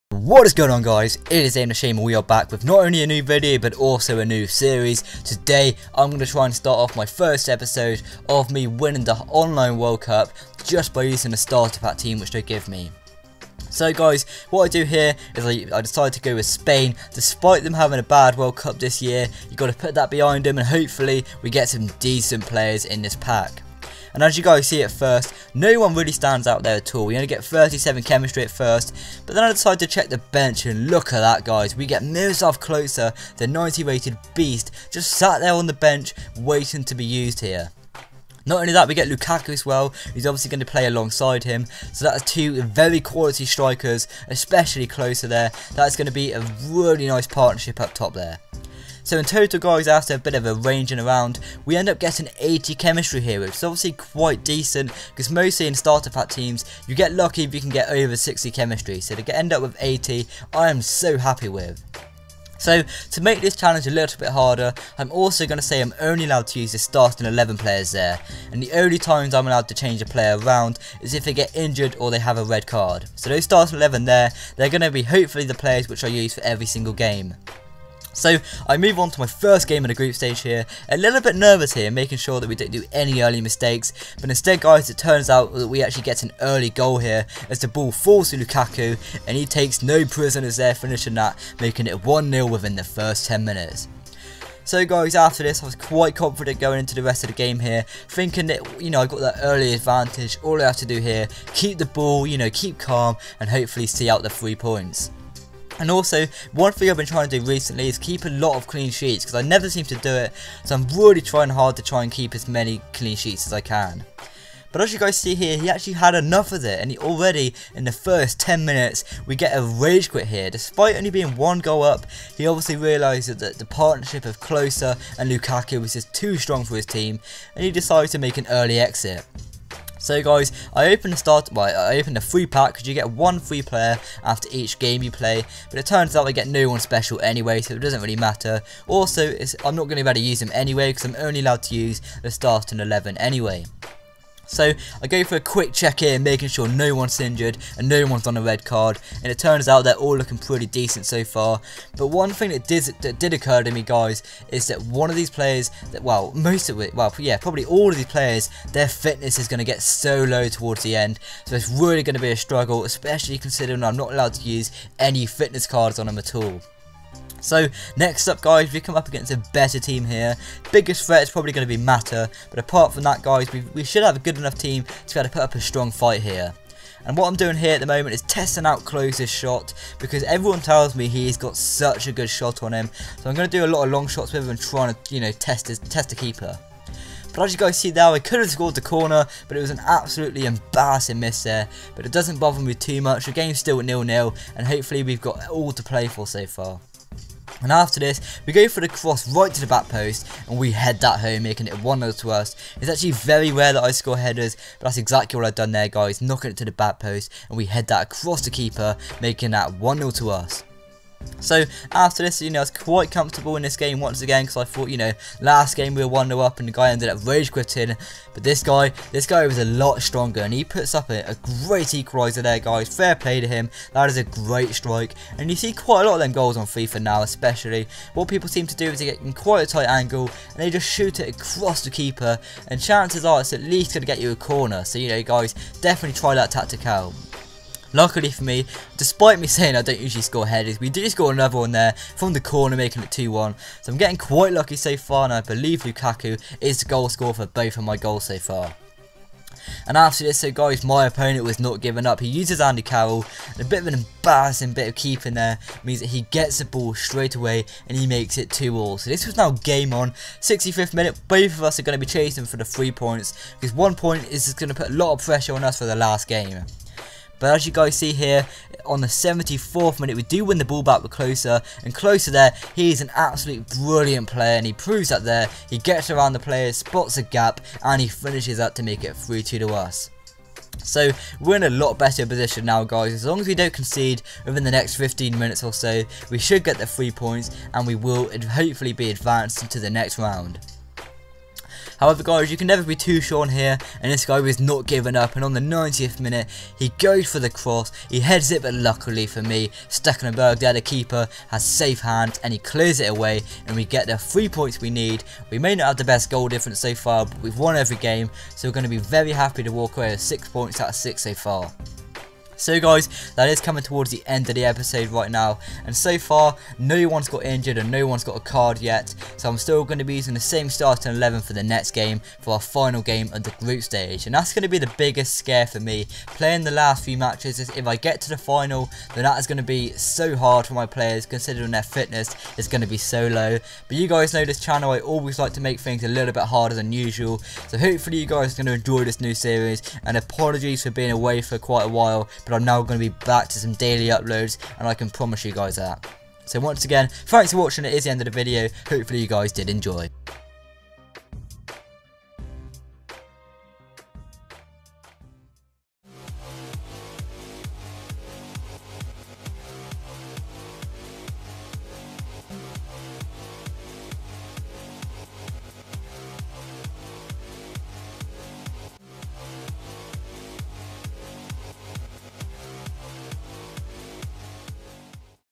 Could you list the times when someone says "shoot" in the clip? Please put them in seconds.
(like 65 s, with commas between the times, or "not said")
230 s.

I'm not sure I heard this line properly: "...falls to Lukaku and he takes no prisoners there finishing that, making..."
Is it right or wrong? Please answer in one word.
right.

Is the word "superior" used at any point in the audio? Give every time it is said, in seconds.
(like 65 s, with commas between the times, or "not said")
not said.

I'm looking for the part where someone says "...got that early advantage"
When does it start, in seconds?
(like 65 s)
99 s.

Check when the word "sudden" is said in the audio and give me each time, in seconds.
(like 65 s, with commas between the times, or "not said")
not said.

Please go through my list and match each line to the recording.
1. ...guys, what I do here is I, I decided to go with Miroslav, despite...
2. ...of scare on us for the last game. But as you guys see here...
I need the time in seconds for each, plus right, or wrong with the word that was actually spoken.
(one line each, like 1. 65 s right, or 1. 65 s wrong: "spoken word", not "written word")
1. 13 s wrong: "Spain", not "Miroslav"
2. 265 s wrong: "pressure", not "scare".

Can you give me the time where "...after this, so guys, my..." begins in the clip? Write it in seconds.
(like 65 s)
249 s.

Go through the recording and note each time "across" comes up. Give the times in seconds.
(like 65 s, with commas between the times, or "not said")
208 s, 231 s.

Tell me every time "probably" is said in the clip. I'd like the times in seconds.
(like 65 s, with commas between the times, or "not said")
157 s, 171 s.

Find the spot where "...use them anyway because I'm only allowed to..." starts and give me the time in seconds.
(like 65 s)
140 s.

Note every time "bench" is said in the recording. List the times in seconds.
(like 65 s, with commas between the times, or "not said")
30 s, 35 s.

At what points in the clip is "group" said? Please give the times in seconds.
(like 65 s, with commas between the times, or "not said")
79 s, 323 s.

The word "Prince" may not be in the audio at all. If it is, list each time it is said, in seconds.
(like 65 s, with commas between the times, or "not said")
not said.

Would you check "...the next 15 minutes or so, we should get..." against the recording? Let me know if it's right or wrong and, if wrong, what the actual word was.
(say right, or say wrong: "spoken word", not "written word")
right.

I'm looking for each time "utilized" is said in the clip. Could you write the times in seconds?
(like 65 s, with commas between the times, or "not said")
not said.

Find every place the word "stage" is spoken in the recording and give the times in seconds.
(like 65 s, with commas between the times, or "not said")
80 s, 323 s.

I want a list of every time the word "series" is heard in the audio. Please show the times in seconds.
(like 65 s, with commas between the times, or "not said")
4 s, 339 s.